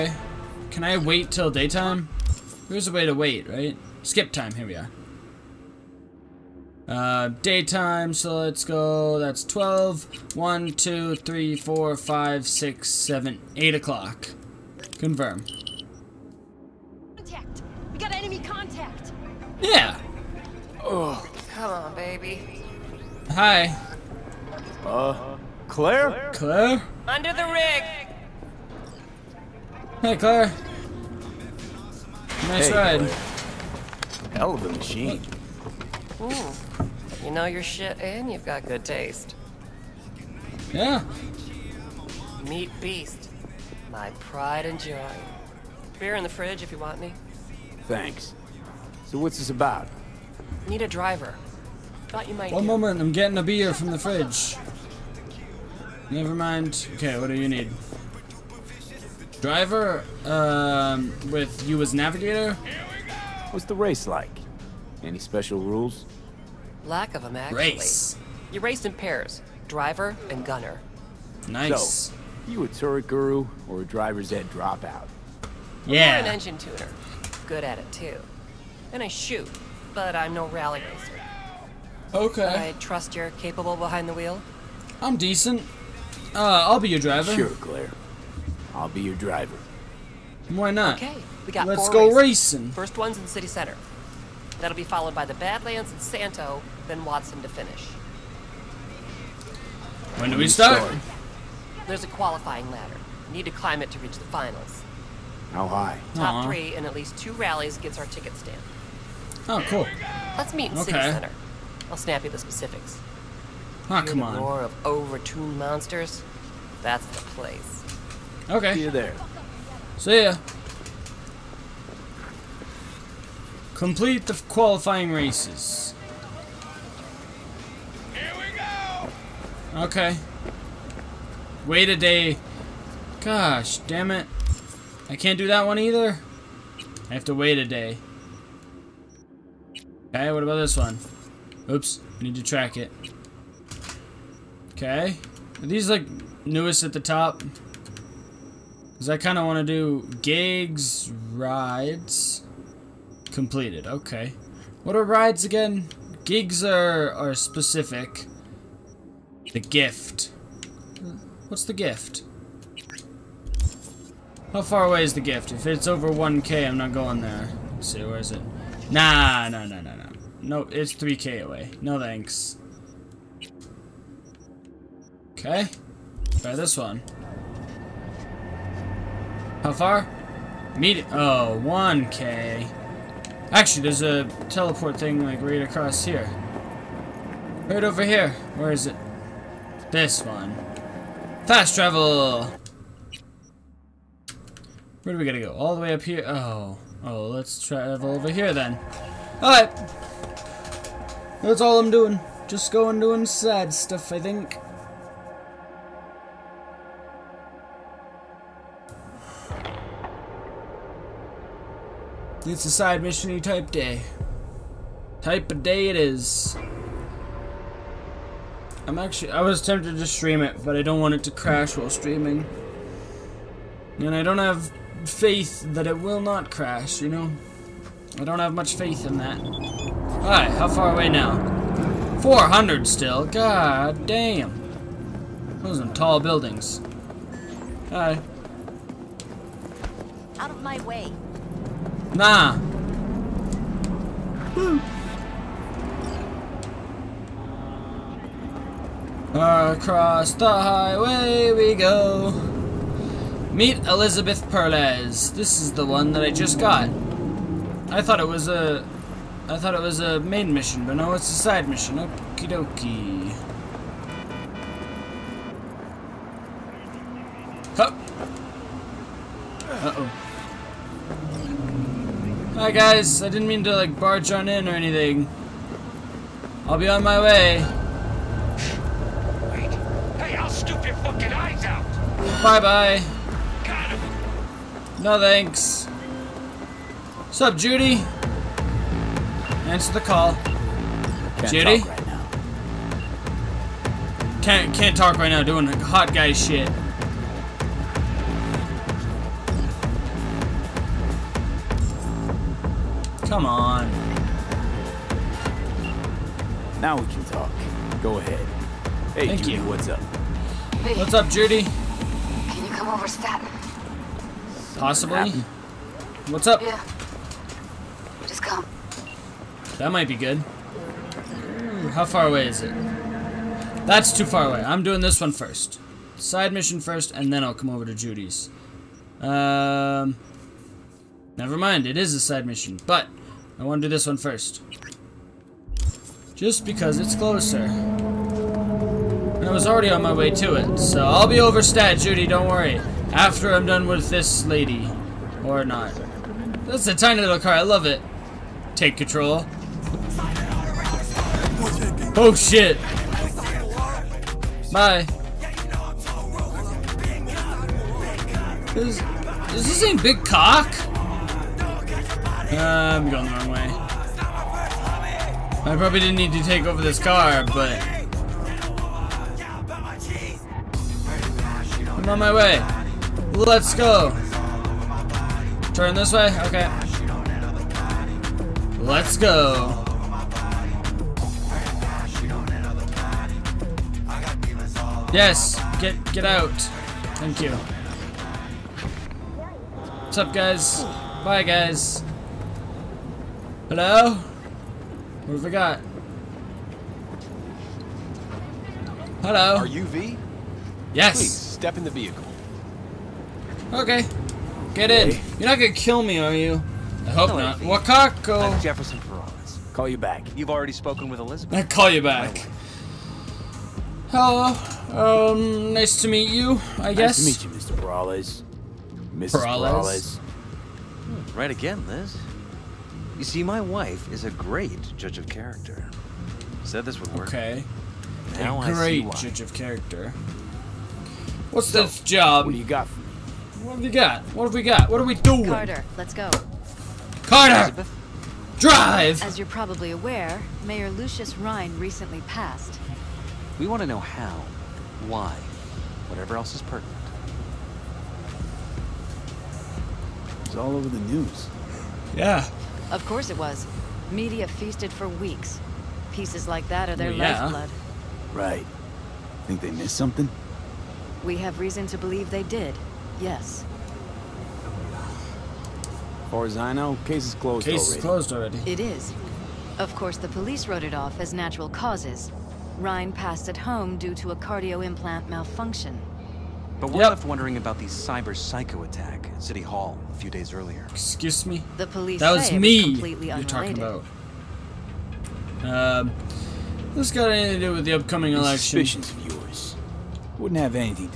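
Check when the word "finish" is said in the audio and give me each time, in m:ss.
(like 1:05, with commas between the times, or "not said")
1:37.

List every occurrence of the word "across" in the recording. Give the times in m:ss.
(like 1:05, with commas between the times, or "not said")
3:05, 4:09.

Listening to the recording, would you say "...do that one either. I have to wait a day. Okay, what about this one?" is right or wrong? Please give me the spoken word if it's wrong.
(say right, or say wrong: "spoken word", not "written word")
right.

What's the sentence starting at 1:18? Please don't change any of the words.
And I shoot, but I'm no rally racer.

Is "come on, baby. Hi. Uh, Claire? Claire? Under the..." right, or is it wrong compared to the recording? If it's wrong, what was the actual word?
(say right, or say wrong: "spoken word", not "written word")
right.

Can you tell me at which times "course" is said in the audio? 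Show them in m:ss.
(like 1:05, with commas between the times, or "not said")
7:33, 7:49.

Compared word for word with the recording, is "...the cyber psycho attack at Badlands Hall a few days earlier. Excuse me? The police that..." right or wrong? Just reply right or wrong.
wrong.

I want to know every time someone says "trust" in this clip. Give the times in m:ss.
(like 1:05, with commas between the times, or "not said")
1:22.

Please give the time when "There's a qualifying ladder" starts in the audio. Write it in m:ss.
1:41.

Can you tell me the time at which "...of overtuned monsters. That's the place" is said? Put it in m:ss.
1:54.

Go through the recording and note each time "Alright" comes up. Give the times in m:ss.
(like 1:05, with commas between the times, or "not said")
3:19, 3:49.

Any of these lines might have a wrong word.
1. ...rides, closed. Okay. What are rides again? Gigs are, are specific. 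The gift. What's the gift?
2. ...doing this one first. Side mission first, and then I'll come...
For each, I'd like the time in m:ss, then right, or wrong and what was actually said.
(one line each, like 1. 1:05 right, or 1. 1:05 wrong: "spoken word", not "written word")
1. 2:31 wrong: "completed", not "closed"
2. 5:24 right.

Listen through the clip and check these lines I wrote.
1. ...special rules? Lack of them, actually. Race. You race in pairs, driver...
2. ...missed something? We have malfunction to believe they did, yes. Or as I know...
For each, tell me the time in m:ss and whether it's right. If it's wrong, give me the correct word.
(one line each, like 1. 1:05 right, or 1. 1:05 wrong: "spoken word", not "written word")
1. 1:05 right
2. 7:39 wrong: "reason", not "malfunction".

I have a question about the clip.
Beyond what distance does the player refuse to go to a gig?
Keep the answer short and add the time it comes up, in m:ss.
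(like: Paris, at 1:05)
1k, at 2:45.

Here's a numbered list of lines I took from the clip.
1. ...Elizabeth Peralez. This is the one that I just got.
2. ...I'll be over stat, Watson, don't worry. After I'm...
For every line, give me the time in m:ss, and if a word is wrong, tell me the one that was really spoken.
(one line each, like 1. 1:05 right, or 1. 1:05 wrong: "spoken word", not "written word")
1. 4:13 right
2. 5:41 wrong: "Judy", not "Watson".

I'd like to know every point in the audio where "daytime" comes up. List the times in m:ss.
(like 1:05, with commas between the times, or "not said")
0:01, 0:07.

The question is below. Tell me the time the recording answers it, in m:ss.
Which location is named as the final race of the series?
1:37.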